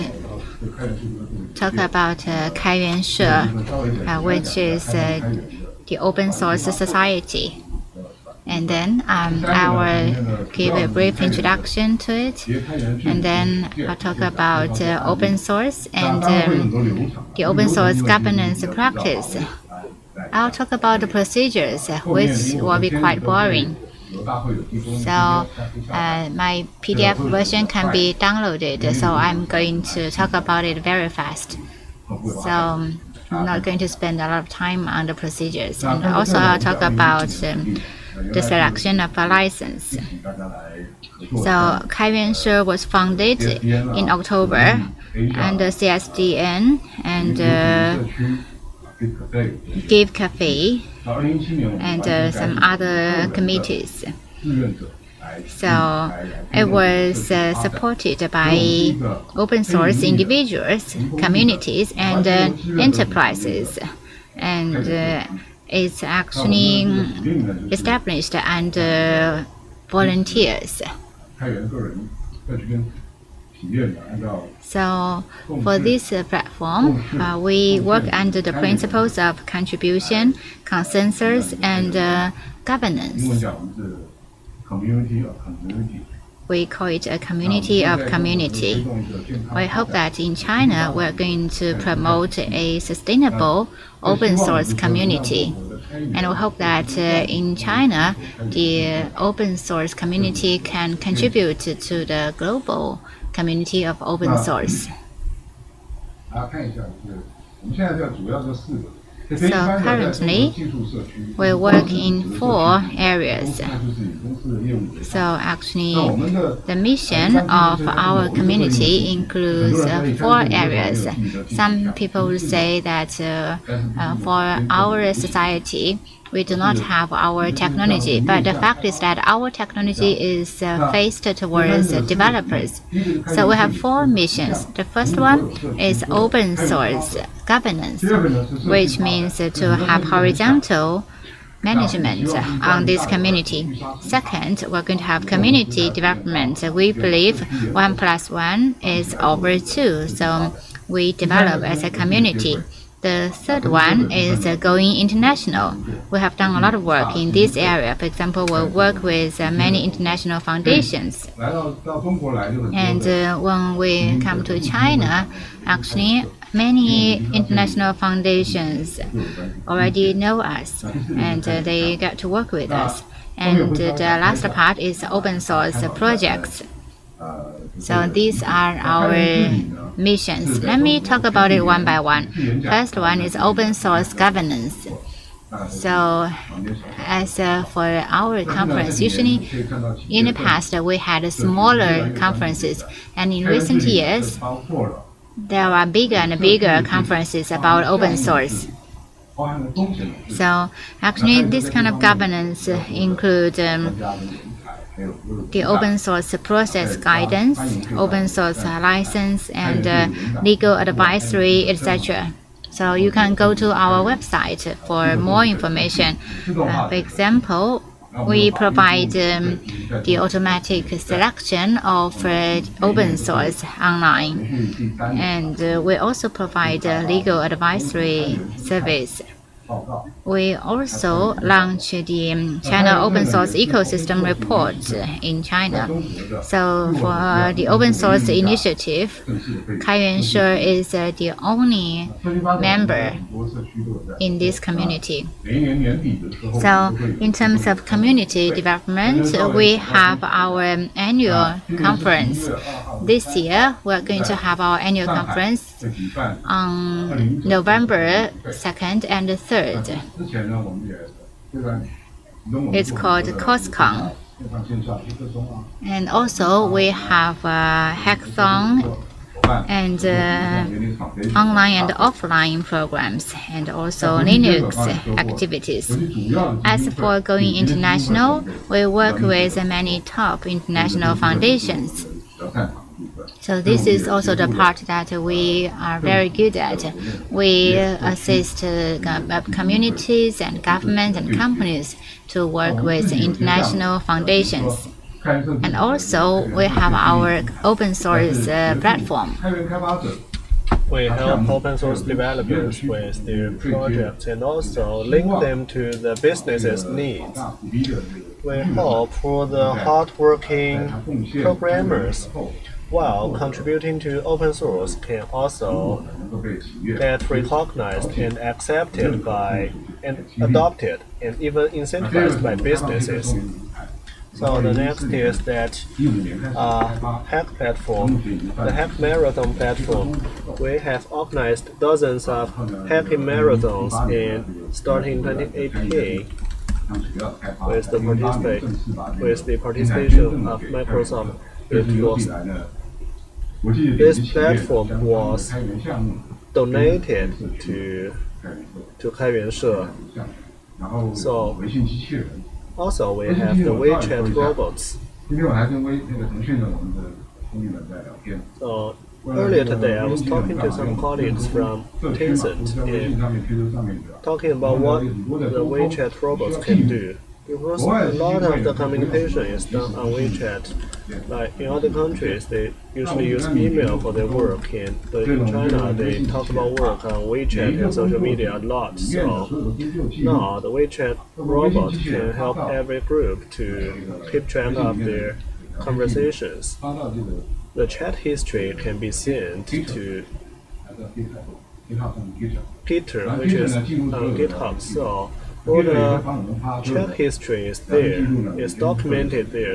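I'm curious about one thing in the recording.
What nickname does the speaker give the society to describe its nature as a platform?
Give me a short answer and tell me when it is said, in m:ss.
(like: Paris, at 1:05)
community of community, at 1:27.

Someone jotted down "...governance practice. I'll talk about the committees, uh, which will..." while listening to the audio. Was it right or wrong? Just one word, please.
wrong.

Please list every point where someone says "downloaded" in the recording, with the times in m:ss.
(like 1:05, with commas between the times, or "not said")
0:28.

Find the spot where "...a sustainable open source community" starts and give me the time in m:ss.
1:32.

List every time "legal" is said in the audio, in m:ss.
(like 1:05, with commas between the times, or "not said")
3:30, 3:47.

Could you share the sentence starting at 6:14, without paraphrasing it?
In, but in China, they talk about work on WeChat and social media a lot.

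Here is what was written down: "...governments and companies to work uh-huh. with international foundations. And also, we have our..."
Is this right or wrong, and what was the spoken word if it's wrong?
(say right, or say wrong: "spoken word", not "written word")
right.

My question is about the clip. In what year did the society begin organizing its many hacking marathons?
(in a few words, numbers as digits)
2018.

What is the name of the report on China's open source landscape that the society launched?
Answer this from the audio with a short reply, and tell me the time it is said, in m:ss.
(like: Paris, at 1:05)
China Open Source Ecosystem Report, at 3:52.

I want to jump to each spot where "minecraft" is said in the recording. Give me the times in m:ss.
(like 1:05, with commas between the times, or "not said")
not said.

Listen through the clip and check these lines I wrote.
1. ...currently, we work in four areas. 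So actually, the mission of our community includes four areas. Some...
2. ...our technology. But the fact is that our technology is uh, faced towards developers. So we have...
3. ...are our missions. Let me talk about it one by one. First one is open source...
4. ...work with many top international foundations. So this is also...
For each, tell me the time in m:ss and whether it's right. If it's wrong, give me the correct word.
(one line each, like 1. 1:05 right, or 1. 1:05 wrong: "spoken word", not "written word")
1. 1:49 right
2. 2:07 right
3. 2:58 right
4. 4:38 right.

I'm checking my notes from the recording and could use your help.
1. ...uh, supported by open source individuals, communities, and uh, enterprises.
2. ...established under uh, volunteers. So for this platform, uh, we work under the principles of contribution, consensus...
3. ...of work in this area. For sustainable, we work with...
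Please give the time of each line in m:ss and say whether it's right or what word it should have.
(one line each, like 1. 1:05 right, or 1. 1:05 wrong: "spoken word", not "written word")
1. 0:57 right
2. 1:07 right
3. 2:36 wrong: "example", not "sustainable".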